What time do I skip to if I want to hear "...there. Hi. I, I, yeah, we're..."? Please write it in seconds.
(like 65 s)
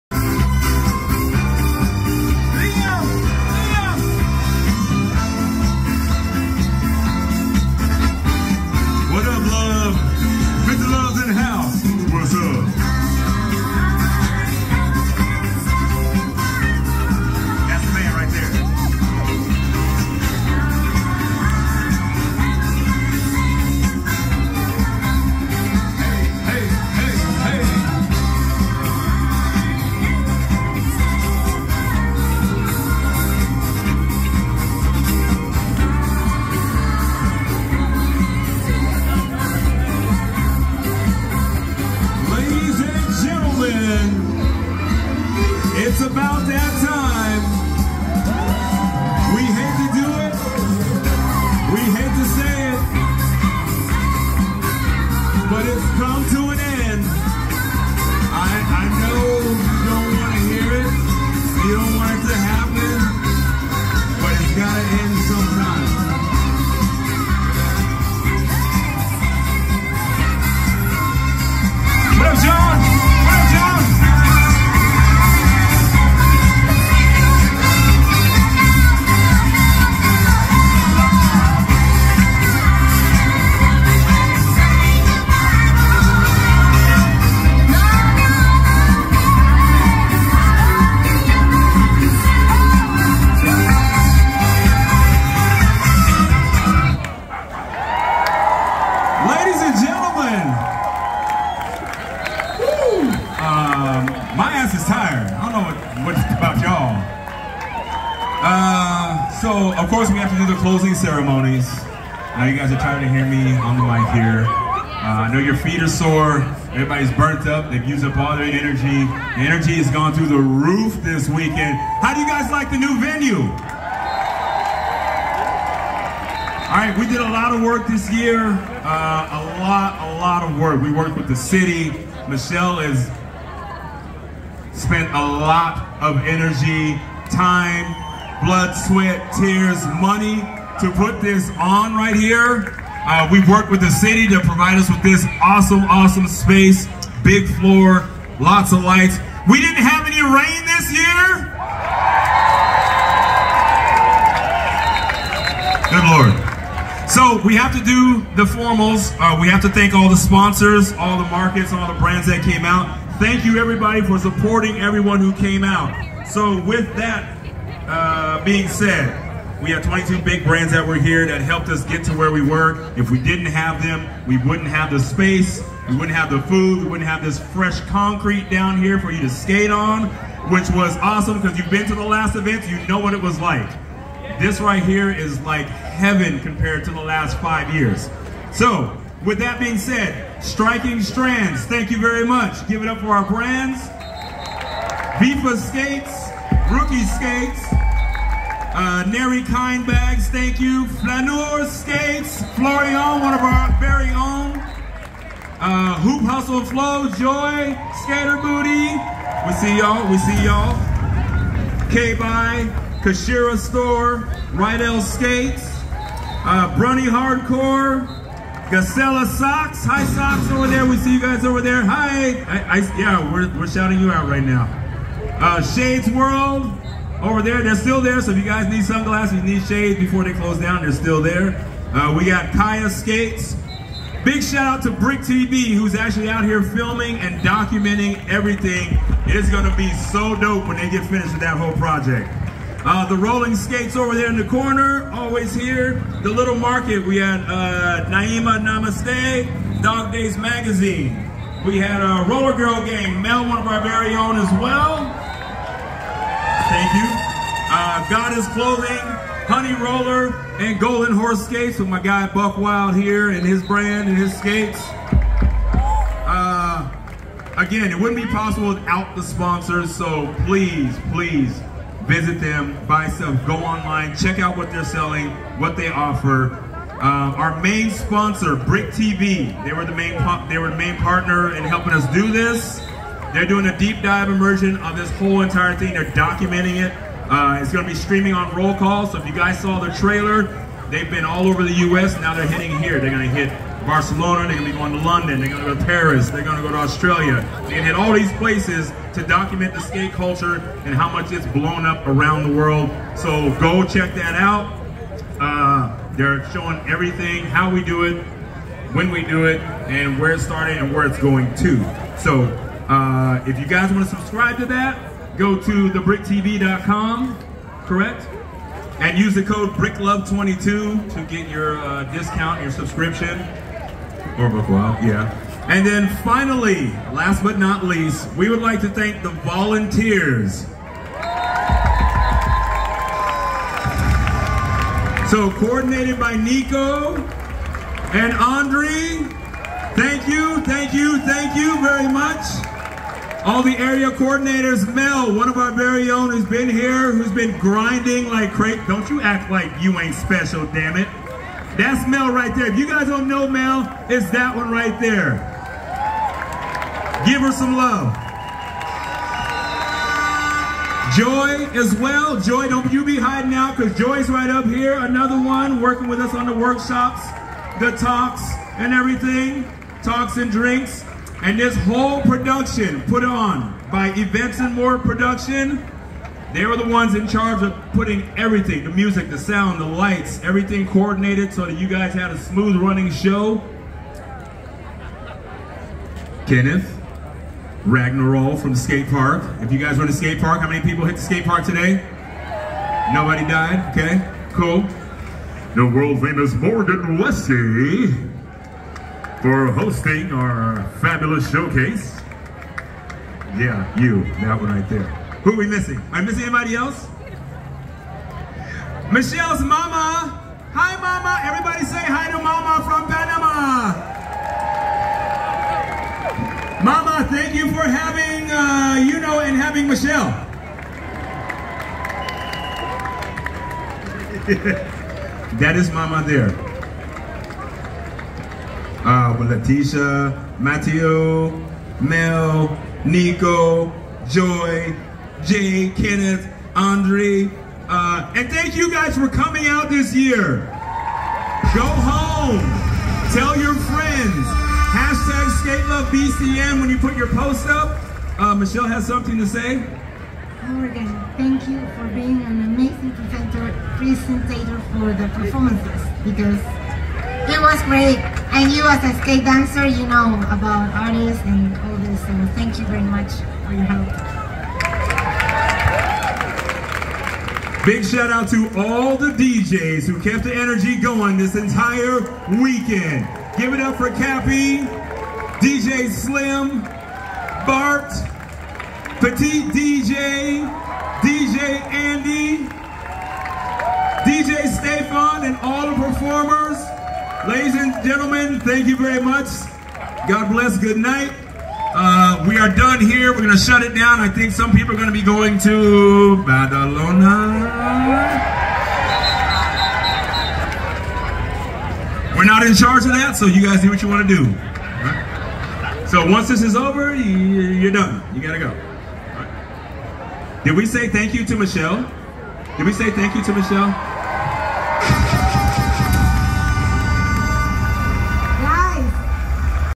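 221 s.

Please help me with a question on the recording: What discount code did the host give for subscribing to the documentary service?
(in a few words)
BRICKLOVE22.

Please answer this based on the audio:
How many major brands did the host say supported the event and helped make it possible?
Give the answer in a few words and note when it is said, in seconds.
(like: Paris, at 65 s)
22, at 169 s.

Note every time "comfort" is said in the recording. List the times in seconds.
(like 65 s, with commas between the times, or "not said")
not said.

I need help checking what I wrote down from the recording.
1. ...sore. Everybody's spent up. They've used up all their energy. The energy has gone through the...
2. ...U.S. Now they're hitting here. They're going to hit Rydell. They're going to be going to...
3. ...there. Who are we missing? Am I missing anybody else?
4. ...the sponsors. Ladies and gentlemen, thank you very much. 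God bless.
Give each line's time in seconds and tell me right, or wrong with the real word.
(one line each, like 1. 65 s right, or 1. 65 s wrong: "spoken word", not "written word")
1. 115 s wrong: "burnt", not "spent"
2. 291 s wrong: "Barcelona", not "Rydell"
3. 404 s right
4. 485 s wrong: "performers", not "sponsors".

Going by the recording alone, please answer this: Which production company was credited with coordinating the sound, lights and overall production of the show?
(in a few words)
Events and More Production.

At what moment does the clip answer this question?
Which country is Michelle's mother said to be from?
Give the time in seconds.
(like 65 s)
413 s.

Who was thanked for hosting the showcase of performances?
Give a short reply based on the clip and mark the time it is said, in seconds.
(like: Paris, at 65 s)
Morgan Leslie, at 396 s.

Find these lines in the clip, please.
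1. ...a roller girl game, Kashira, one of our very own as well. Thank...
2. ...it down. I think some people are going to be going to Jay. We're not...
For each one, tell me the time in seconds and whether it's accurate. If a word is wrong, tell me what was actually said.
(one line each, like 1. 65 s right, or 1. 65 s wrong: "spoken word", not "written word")
1. 252 s wrong: "Mel", not "Kashira"
2. 493 s wrong: "Badalona", not "Jay".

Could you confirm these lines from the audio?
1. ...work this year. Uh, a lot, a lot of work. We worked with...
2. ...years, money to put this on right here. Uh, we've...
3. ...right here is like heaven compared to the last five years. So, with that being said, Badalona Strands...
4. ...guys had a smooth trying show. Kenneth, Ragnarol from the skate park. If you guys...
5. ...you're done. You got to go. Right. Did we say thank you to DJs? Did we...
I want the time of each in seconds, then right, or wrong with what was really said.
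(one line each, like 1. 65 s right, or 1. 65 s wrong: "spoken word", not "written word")
1. 127 s right
2. 139 s wrong: "tears", not "years"
3. 184 s wrong: "Striking", not "Badalona"
4. 381 s wrong: "running", not "trying"
5. 507 s wrong: "Michelle", not "DJs".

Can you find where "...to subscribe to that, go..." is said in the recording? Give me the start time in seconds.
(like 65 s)
314 s.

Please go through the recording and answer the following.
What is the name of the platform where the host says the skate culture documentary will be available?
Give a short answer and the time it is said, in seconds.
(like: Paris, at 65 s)
Roll Call, at 288 s.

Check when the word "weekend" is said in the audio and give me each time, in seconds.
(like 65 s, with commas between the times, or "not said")
121 s, 472 s.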